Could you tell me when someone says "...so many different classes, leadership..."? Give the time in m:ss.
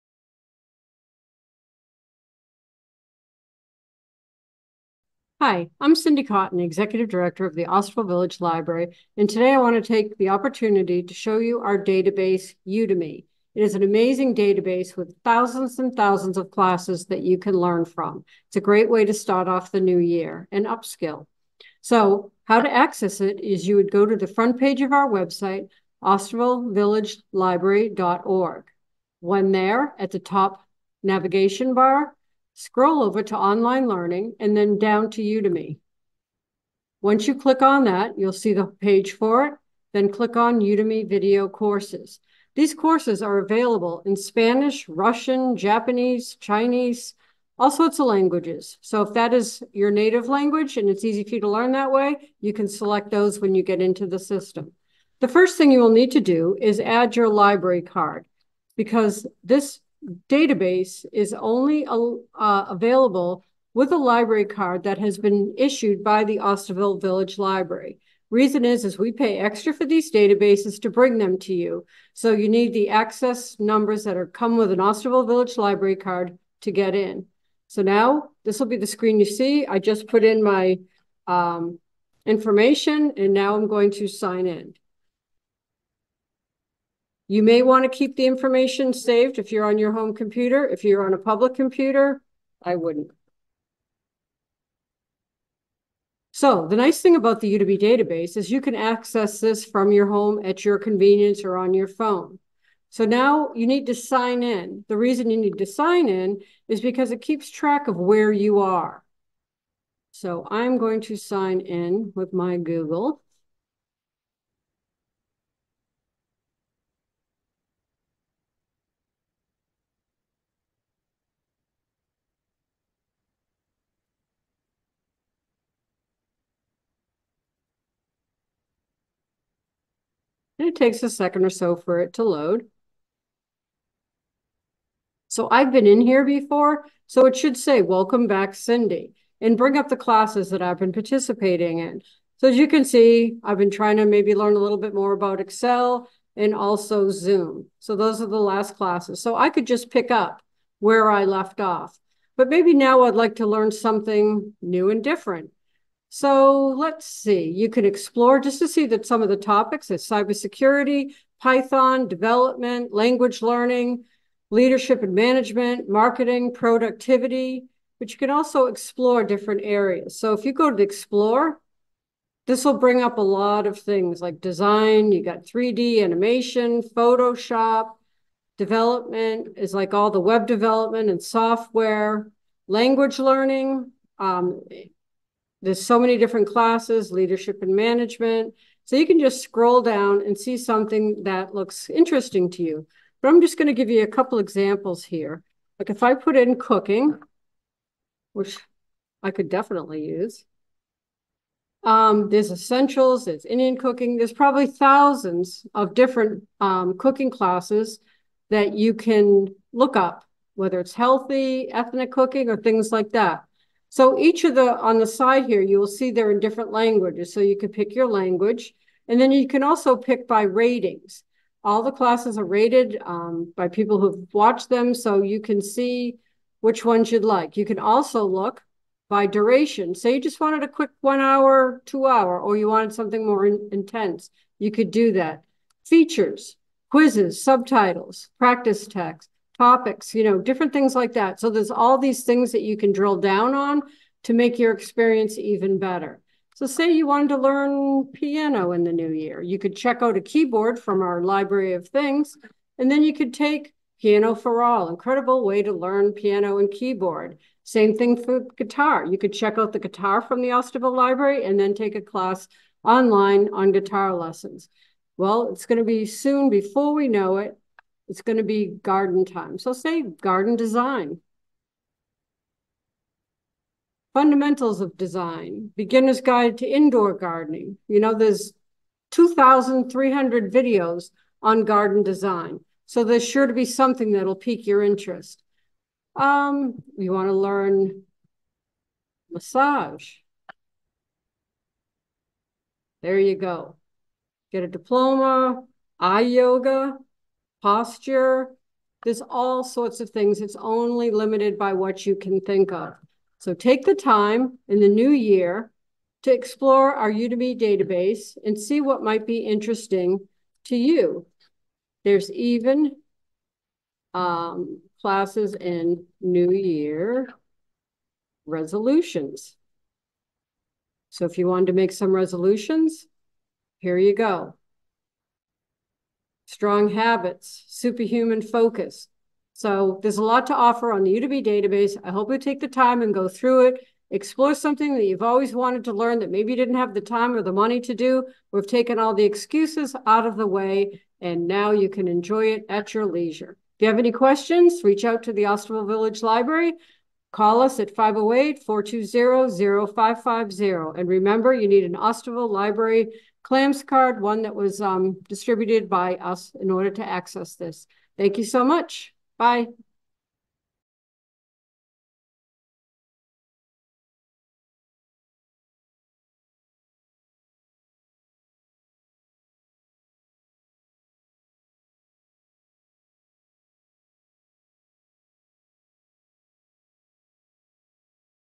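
3:05.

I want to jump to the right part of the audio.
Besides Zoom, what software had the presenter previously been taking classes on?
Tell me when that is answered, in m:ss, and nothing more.
2:25.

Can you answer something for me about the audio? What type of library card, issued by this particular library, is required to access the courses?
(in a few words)
CLAMS card.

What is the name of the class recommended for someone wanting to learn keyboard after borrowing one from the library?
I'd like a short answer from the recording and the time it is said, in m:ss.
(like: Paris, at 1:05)
Piano for All, at 4:14.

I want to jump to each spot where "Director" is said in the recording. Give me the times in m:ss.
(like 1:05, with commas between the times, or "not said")
0:07.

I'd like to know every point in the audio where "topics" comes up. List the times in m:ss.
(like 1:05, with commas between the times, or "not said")
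2:39, 3:59.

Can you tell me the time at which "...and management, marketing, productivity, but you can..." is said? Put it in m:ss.
2:45.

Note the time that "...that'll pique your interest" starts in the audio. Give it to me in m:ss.
4:44.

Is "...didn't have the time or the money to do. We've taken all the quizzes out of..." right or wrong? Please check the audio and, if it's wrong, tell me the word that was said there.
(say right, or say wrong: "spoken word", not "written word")
wrong: "excuses", not "quizzes".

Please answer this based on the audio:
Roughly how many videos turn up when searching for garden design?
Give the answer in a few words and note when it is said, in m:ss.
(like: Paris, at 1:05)
2,300, at 4:39.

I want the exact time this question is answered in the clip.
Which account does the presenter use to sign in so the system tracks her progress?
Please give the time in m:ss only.
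1:52.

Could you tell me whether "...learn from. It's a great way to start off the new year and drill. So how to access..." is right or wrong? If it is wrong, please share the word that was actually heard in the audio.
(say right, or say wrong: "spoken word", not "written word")
wrong: "upskill", not "drill".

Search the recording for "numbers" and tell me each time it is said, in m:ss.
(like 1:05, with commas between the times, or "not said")
1:13.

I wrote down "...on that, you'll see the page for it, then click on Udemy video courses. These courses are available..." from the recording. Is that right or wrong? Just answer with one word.
right.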